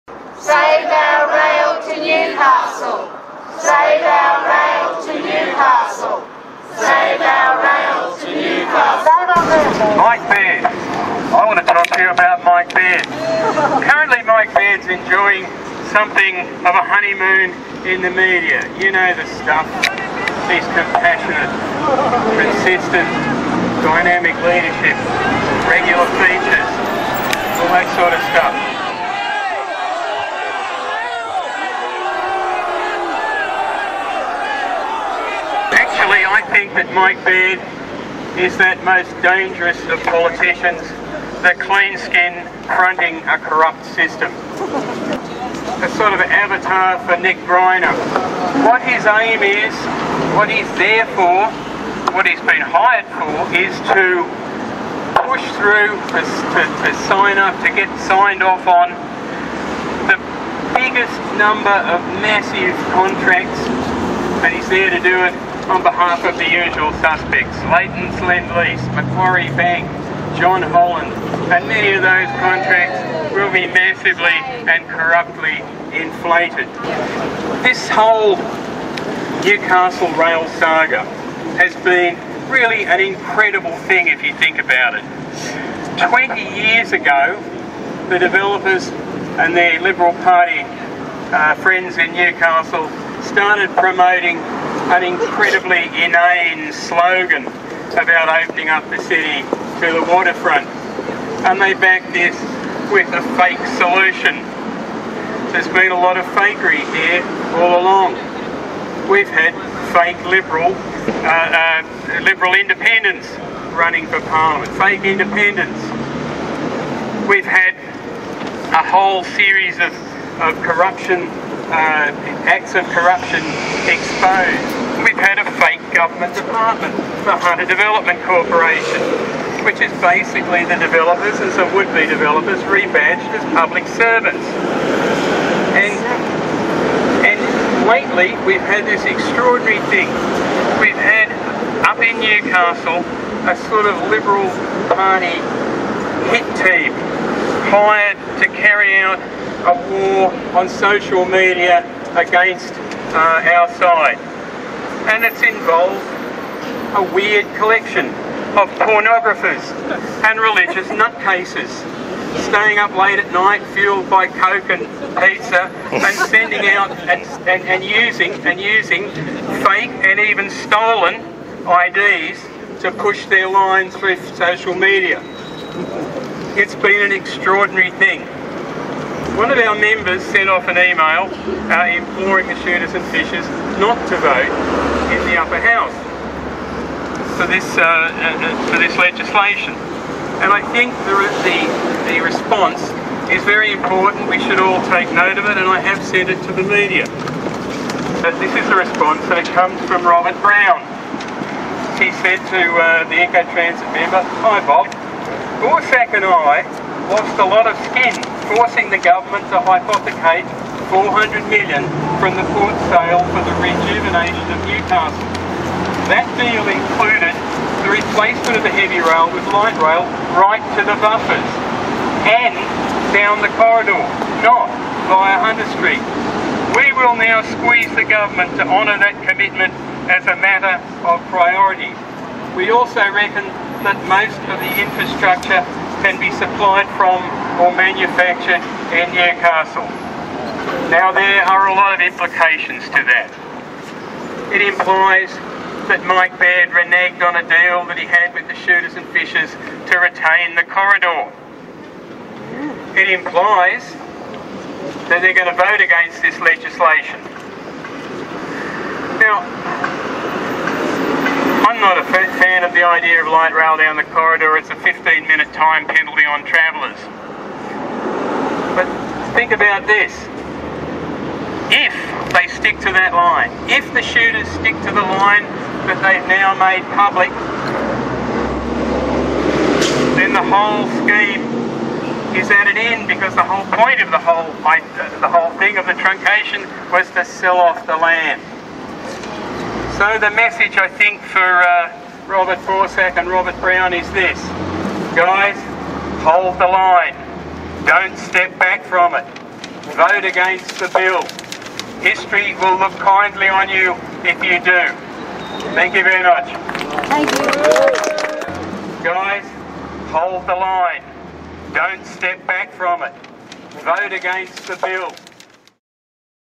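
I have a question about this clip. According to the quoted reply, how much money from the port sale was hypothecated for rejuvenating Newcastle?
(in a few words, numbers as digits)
400 million.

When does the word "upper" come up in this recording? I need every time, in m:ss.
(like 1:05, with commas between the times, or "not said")
3:05.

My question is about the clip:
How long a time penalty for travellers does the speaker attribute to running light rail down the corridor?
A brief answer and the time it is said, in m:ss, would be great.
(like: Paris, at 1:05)
15 minutes, at 4:24.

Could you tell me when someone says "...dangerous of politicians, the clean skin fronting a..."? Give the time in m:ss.
0:39.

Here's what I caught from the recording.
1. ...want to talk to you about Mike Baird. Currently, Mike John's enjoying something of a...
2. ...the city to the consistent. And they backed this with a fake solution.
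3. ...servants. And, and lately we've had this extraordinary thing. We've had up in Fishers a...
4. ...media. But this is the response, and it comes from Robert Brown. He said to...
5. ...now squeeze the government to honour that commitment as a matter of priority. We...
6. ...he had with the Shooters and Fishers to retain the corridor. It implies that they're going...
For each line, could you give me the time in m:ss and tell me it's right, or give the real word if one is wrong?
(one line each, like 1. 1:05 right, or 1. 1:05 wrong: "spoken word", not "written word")
1. 0:11 wrong: "Baird", not "John"
2. 1:38 wrong: "waterfront", not "consistent"
3. 2:13 wrong: "Newcastle", not "Fishers"
4. 3:16 right
5. 3:47 right
6. 4:08 right.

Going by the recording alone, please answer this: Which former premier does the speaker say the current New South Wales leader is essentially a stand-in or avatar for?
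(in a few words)
Nick Greiner.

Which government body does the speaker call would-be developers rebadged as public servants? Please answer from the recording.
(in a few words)
Hunter Development Corporation.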